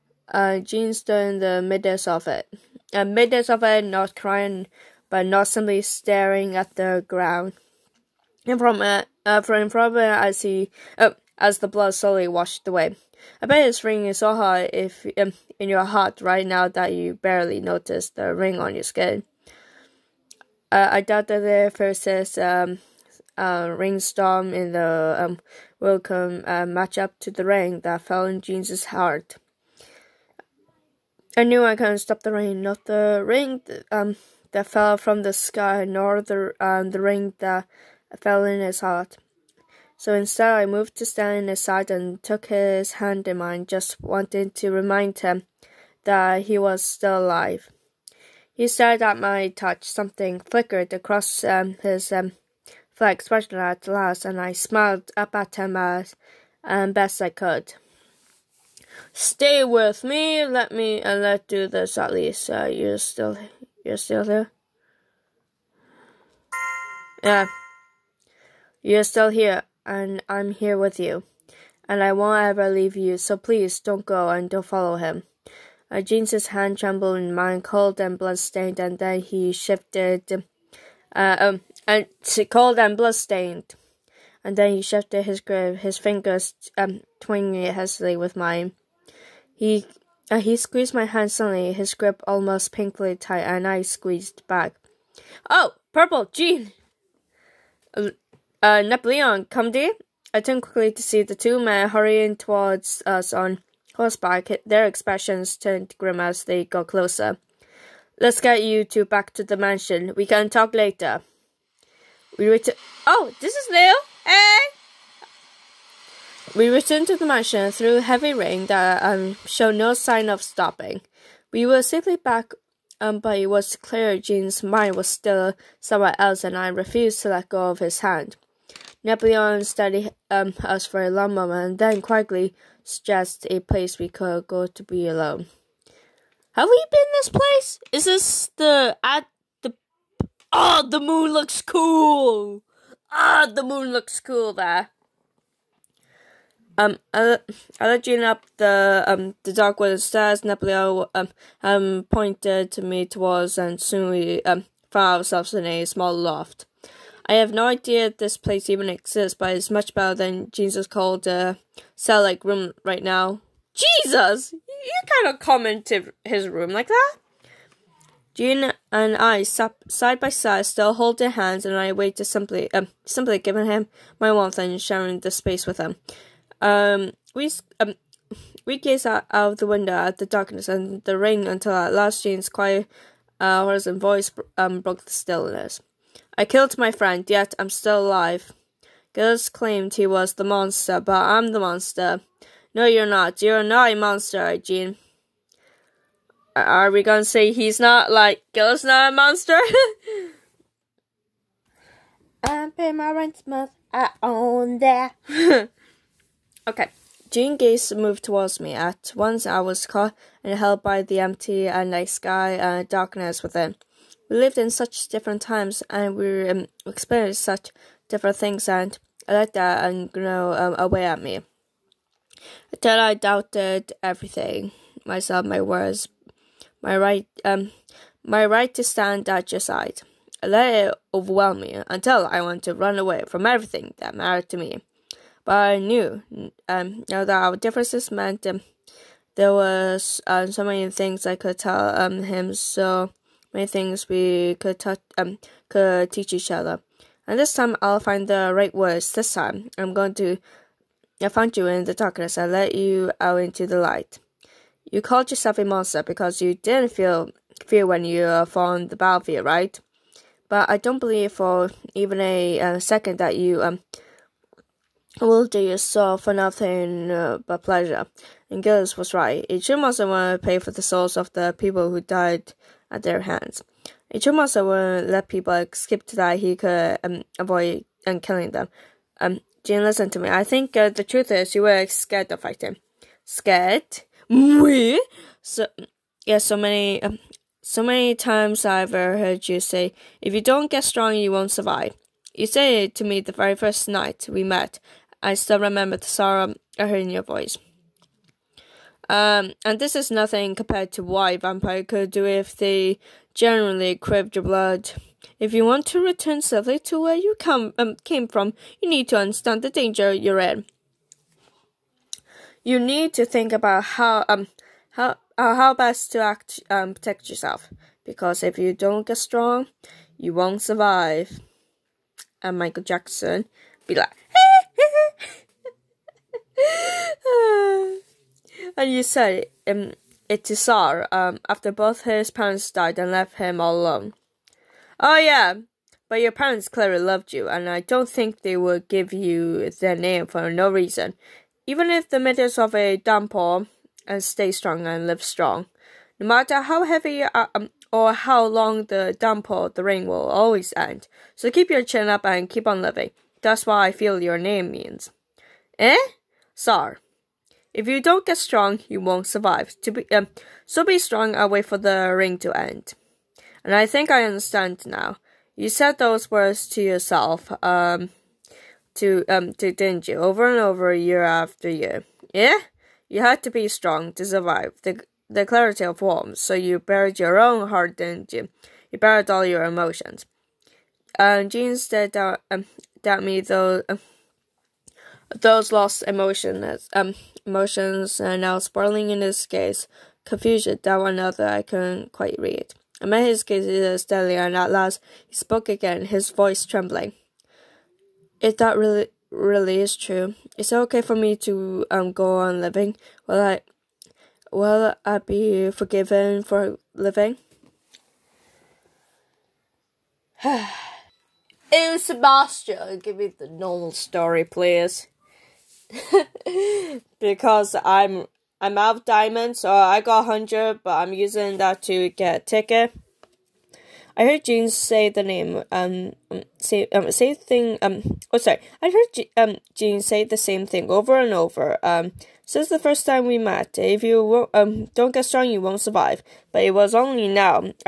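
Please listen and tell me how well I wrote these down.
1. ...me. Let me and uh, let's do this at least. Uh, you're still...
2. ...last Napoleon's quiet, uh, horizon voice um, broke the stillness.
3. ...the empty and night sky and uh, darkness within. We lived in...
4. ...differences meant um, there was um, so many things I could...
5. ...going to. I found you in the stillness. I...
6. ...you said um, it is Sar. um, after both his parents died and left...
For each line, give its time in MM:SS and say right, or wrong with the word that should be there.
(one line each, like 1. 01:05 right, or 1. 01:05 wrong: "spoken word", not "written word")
1. 01:00 right
2. 03:01 wrong: "Jane", not "Napoleon"
3. 03:31 right
4. 03:57 right
5. 04:09 wrong: "darkness", not "stillness"
6. 05:28 right.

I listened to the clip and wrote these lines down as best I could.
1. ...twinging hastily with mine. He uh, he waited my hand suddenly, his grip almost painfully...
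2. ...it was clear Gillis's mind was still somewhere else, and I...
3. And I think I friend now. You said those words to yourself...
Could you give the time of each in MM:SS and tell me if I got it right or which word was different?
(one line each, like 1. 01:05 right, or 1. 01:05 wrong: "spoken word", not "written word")
1. 01:27 wrong: "squeezed", not "waited"
2. 02:03 wrong: "Jean", not "Gillis"
3. 06:03 wrong: "understand", not "friend".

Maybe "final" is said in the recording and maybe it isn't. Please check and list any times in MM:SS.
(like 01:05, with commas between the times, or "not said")
not said.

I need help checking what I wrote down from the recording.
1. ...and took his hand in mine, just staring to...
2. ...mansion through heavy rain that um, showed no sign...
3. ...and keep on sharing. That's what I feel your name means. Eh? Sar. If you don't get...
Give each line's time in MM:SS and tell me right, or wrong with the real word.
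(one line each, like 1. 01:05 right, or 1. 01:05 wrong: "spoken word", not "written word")
1. 00:41 wrong: "wanting", not "staring"
2. 01:57 right
3. 05:52 wrong: "living", not "sharing".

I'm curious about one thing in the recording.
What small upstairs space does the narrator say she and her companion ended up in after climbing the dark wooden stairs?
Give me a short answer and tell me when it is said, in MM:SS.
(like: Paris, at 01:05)
a small loft, at 02:35.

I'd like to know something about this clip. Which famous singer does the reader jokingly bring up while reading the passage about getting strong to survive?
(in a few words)
Michael Jackson.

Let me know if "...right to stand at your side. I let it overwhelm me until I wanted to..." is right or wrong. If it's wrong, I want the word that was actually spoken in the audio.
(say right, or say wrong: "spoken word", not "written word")
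right.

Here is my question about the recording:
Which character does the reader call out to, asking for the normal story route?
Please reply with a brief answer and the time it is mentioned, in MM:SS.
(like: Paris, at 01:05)
Sebastian, at 06:52.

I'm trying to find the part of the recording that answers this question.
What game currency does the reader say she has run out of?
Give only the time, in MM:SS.
06:59.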